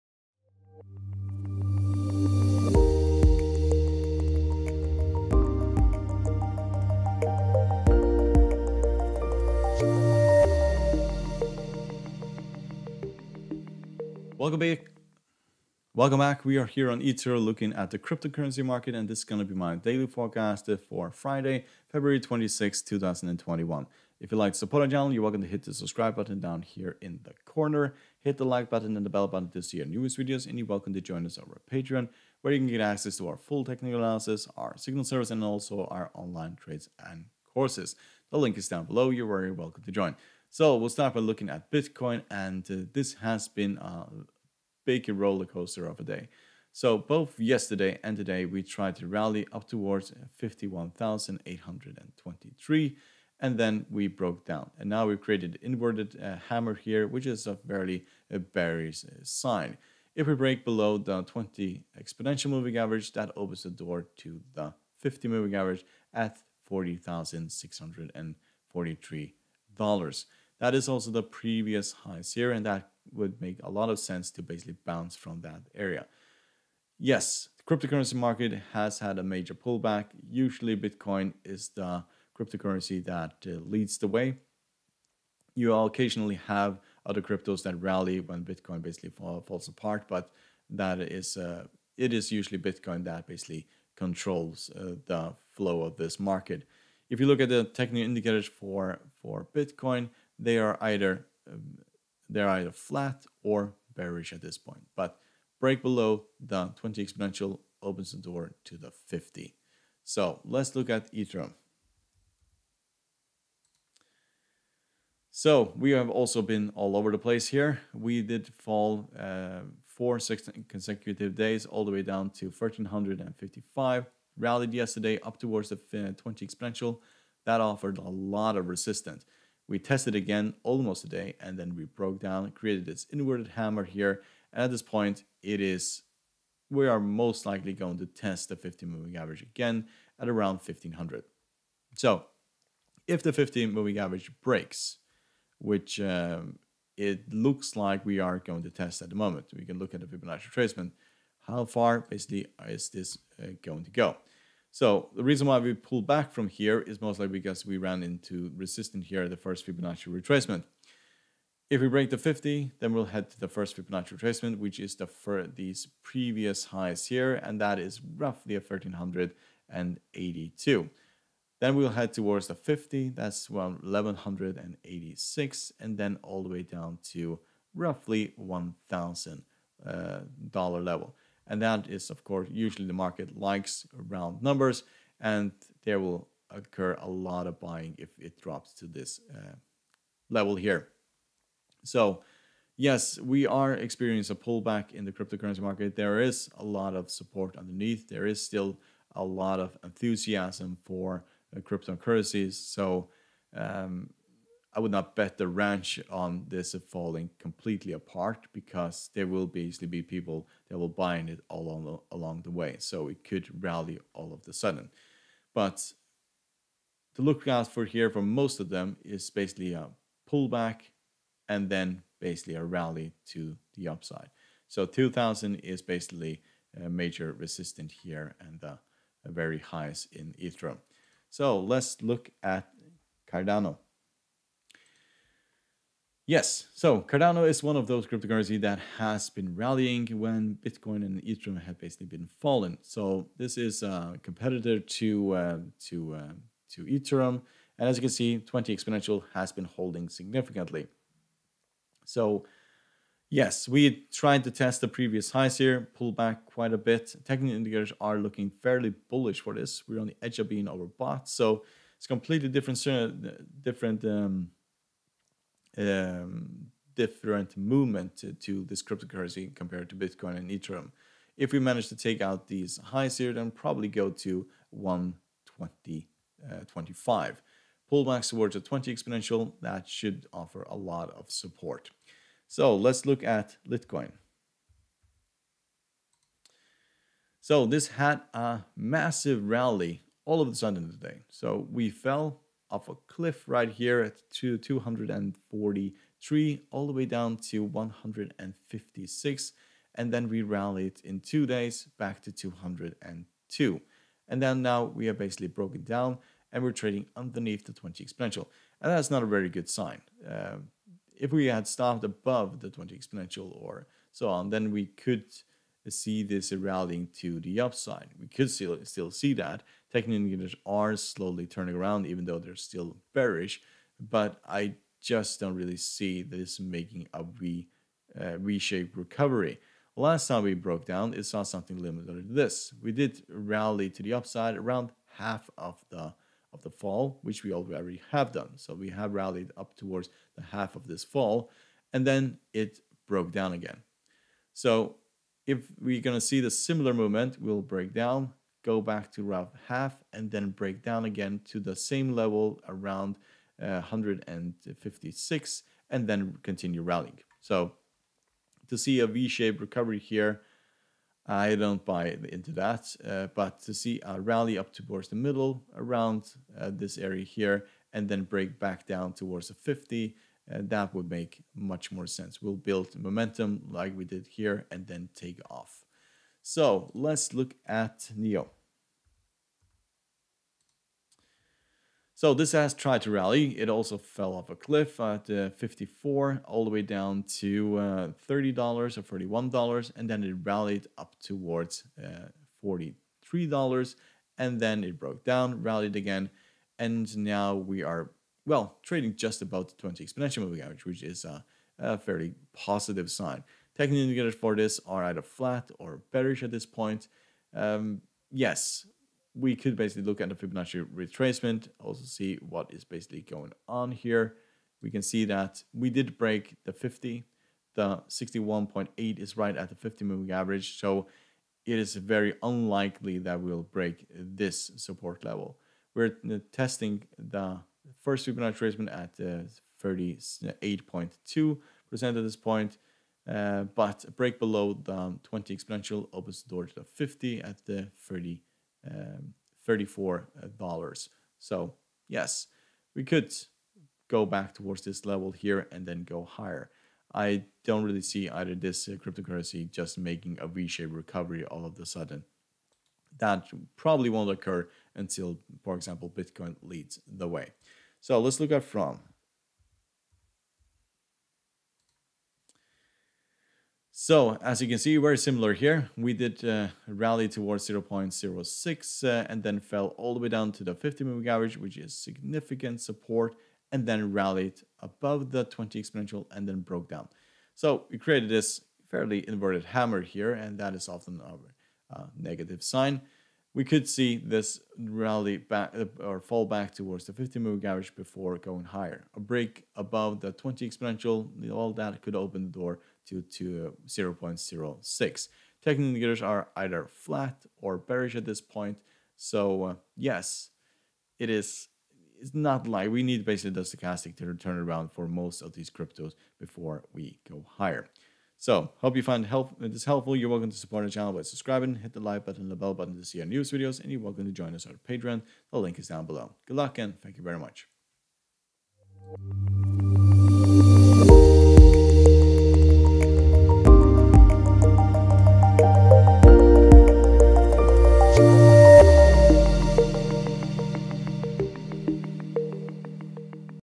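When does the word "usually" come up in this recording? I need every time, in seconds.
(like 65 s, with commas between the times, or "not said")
80 s, 92 s, 182 s.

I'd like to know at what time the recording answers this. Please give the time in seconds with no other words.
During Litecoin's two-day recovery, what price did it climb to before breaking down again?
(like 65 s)
302 s.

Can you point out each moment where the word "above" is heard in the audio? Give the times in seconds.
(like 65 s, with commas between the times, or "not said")
312 s, 474 s, 489 s.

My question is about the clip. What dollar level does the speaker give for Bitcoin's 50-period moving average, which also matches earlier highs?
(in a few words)
$40,643.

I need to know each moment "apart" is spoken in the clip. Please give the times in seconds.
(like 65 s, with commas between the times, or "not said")
89 s, 207 s.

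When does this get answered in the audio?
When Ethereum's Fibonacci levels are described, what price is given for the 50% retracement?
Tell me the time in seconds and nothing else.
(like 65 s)
173 s.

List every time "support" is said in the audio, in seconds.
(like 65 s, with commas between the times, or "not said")
24 s, 197 s, 281 s, 424 s, 472 s, 510 s.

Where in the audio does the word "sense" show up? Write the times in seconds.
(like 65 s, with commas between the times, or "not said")
73 s, 372 s.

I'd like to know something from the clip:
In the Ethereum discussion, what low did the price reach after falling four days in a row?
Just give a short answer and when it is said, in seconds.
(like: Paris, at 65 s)
1355, at 122 s.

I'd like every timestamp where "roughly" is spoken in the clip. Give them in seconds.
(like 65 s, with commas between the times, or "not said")
168 s, 177 s.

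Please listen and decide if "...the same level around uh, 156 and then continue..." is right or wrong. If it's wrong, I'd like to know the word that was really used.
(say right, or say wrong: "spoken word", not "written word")
right.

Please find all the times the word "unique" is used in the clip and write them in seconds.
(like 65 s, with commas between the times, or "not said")
not said.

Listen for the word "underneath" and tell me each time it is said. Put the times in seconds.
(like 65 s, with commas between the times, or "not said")
197 s, 307 s.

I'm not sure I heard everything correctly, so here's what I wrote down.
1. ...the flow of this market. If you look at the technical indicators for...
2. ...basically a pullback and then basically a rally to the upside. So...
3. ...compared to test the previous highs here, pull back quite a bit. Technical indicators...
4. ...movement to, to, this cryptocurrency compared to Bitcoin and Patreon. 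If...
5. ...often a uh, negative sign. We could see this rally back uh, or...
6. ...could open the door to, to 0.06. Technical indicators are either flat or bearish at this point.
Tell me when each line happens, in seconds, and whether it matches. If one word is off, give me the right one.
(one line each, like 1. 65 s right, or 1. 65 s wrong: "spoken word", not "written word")
1. 95 s right
2. 219 s right
3. 254 s wrong: "tried", not "compared"
4. 267 s wrong: "Ethereum", not "Patreon"
5. 480 s right
6. 492 s right.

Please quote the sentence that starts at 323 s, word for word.
But I just don't really see this making a V uh, V-shaped recovery.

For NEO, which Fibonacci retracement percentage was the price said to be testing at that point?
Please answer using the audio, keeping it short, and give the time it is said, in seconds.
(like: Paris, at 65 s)
38.2%, at 429 s.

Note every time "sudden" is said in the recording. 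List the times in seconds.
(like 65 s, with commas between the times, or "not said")
214 s, 290 s, 451 s.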